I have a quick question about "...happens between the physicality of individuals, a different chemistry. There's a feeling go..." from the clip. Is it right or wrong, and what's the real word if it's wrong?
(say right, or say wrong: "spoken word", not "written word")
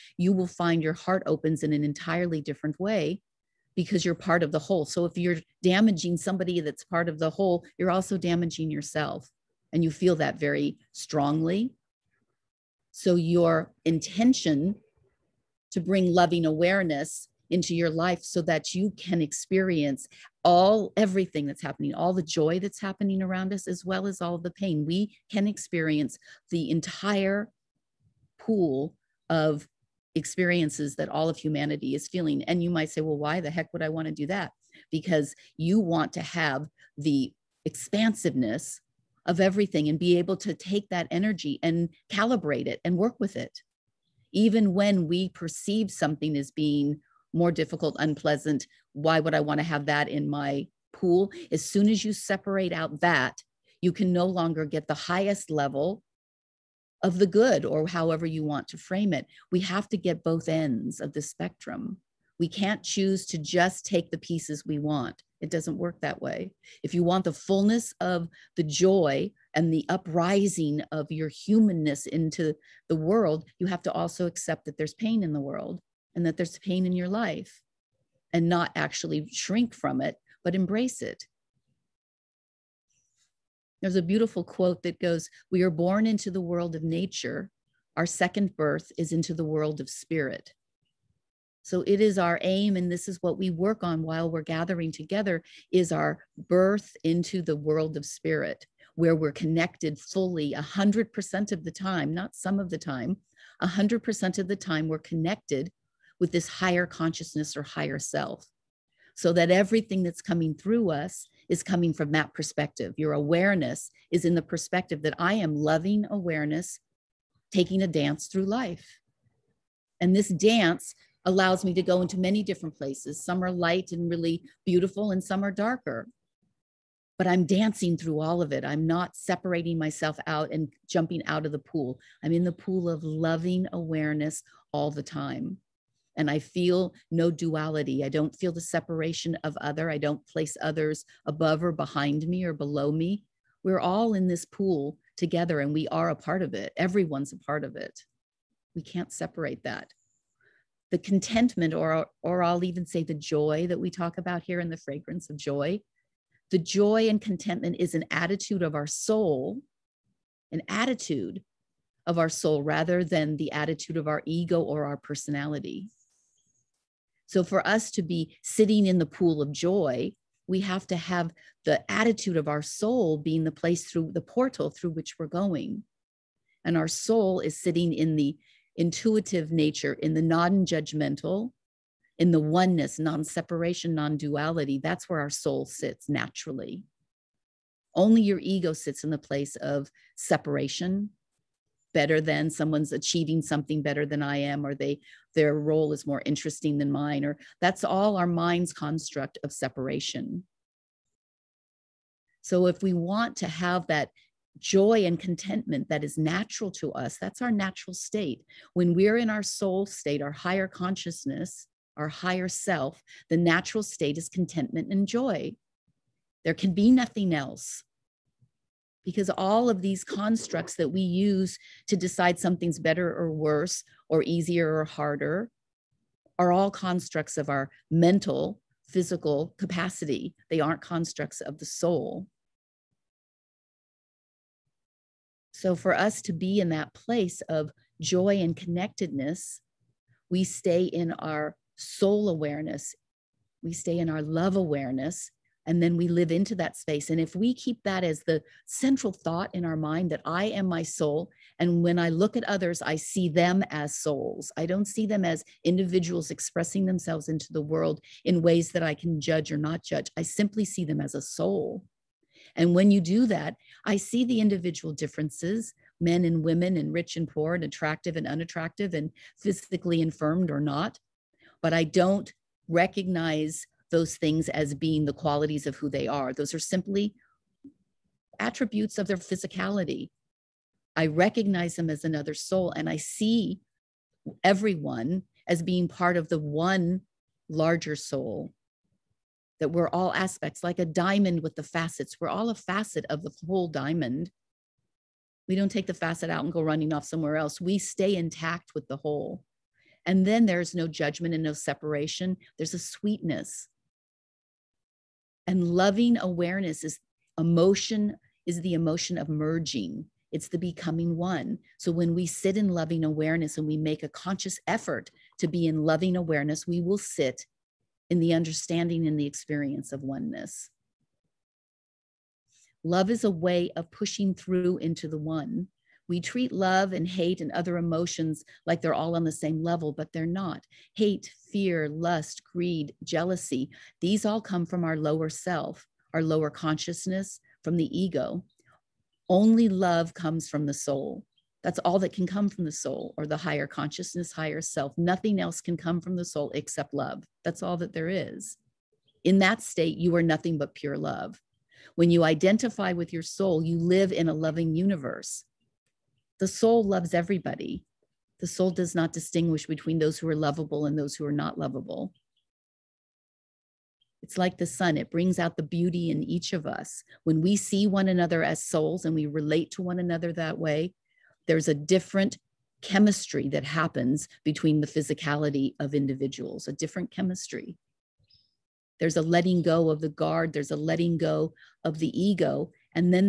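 wrong: "letting", not "feeling".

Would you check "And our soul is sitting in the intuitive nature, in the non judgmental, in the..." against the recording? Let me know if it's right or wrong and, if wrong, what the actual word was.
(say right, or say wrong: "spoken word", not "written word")
right.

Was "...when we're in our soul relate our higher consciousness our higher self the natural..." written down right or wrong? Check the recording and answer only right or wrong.
wrong.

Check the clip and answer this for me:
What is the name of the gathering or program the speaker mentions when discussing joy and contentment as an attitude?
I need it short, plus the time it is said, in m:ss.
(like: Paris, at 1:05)
The Fragrance of Joy, at 2:34.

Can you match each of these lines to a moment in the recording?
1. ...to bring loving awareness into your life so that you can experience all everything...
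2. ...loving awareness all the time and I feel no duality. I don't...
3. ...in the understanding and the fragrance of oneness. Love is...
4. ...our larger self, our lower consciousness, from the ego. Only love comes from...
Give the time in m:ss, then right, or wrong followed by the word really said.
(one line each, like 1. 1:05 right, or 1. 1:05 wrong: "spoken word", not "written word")
1. 0:15 right
2. 2:13 right
3. 5:18 wrong: "experience", not "fragrance"
4. 5:34 wrong: "lower", not "larger".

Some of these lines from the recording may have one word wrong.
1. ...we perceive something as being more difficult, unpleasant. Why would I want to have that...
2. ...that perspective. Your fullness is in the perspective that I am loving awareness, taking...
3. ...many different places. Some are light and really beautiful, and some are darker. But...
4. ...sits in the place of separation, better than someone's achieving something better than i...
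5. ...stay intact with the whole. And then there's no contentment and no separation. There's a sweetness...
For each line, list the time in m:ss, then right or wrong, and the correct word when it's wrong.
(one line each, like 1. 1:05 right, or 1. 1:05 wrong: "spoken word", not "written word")
1. 0:45 right
2. 1:52 wrong: "awareness", not "fullness"
3. 2:02 right
4. 3:08 right
5. 4:57 wrong: "judgment", not "contentment".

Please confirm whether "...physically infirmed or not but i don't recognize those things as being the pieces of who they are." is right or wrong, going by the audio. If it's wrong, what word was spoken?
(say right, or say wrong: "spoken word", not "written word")
wrong: "qualities", not "pieces".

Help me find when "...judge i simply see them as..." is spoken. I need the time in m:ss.
4:19.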